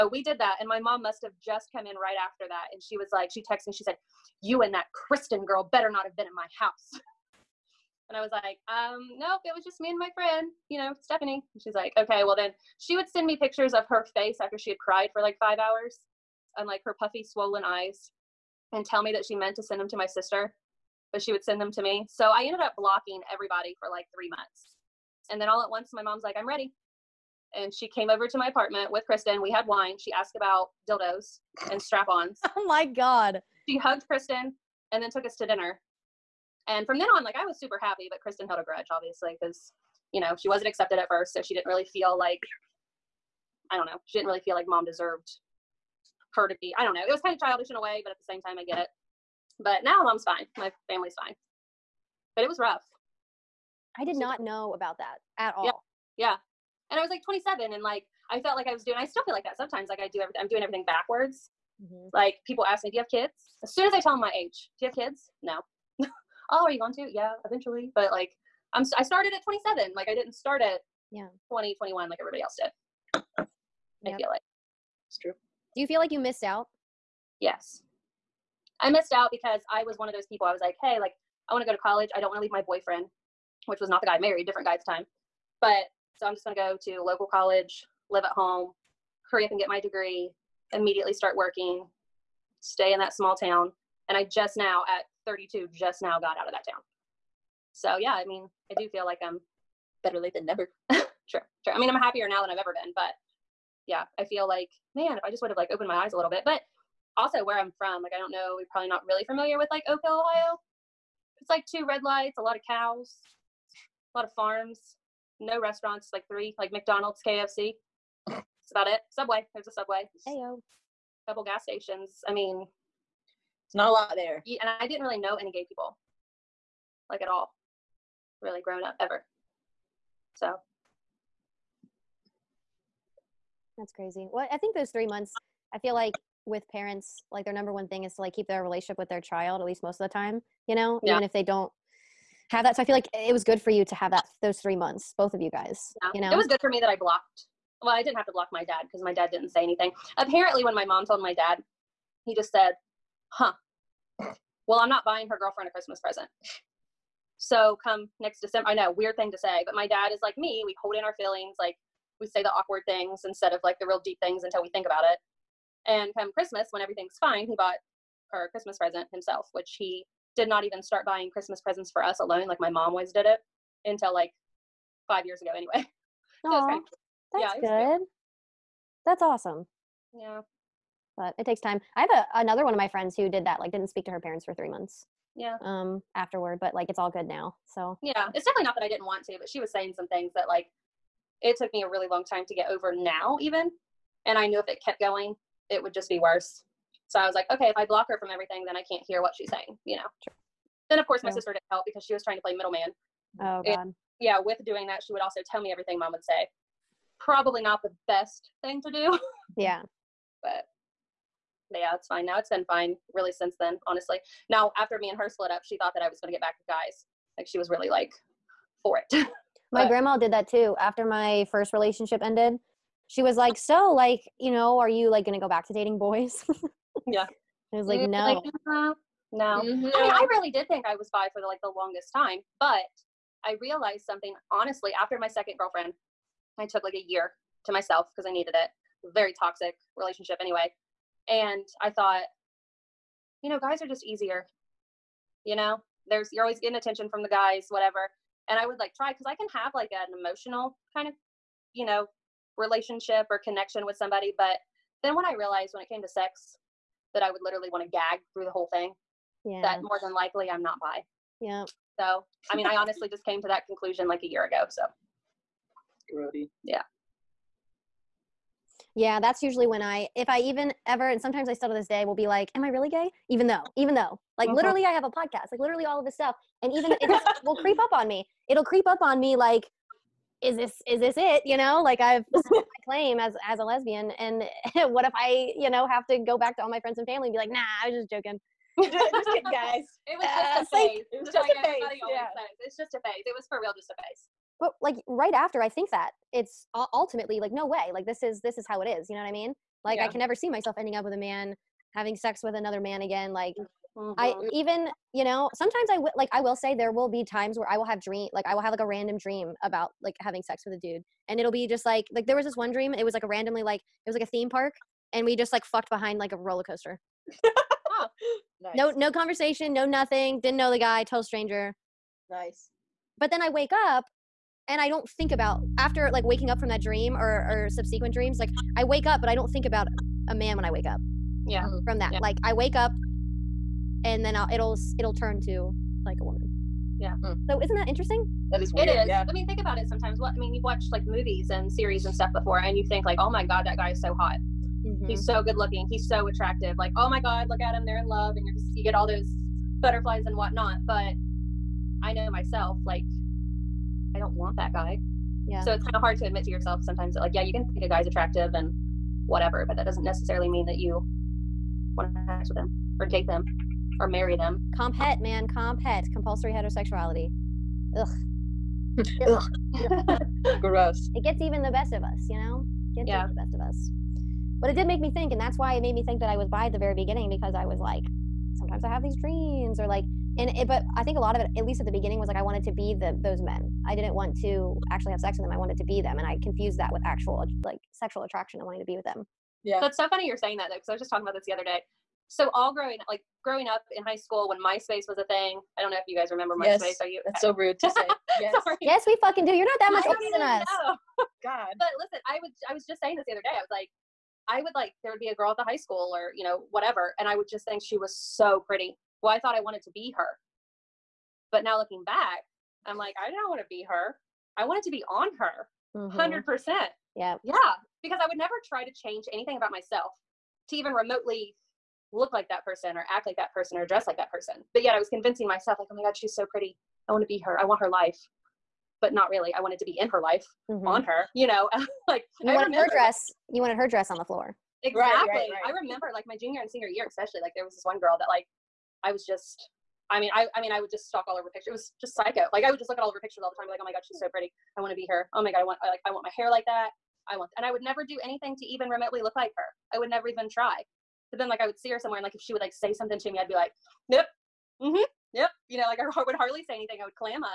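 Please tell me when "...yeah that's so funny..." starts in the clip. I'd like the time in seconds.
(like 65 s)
389 s.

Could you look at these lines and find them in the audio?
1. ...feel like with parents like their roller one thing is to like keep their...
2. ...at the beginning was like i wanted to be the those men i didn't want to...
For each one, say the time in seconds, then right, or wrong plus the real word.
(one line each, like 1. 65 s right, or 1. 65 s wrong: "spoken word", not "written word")
1. 135 s wrong: "number", not "roller"
2. 381 s right.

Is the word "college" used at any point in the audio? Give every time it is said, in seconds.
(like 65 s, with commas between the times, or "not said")
81 s, 87 s.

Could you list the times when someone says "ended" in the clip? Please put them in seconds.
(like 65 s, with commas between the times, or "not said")
22 s, 222 s.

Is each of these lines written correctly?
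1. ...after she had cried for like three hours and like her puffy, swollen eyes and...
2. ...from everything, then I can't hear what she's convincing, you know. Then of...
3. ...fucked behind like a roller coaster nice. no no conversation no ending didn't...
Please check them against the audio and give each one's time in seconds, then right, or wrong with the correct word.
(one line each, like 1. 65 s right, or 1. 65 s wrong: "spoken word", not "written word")
1. 14 s wrong: "five", not "three"
2. 198 s wrong: "saying", not "convincing"
3. 315 s wrong: "nothing", not "ending".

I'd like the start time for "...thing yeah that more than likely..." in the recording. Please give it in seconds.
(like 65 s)
258 s.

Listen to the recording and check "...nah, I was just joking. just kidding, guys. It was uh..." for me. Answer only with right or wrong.
right.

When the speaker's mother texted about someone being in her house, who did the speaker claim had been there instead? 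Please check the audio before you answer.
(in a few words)
Stephanie.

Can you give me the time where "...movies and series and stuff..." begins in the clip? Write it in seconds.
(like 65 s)
341 s.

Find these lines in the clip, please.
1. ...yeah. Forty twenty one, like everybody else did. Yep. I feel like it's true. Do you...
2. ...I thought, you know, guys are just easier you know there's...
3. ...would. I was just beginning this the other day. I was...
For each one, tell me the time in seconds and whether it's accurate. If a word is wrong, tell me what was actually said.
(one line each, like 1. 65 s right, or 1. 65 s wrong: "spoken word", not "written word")
1. 71 s wrong: "Twenty", not "Forty"
2. 241 s right
3. 402 s wrong: "saying", not "beginning".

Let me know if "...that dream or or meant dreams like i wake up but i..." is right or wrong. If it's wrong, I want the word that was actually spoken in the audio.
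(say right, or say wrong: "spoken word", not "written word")
wrong: "subsequent", not "meant".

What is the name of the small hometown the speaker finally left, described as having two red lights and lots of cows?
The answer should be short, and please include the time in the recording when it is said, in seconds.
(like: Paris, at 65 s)
Oak Hill, Ohio, at 109 s.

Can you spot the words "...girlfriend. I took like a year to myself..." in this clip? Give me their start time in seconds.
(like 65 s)
235 s.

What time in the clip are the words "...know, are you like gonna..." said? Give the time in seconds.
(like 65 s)
224 s.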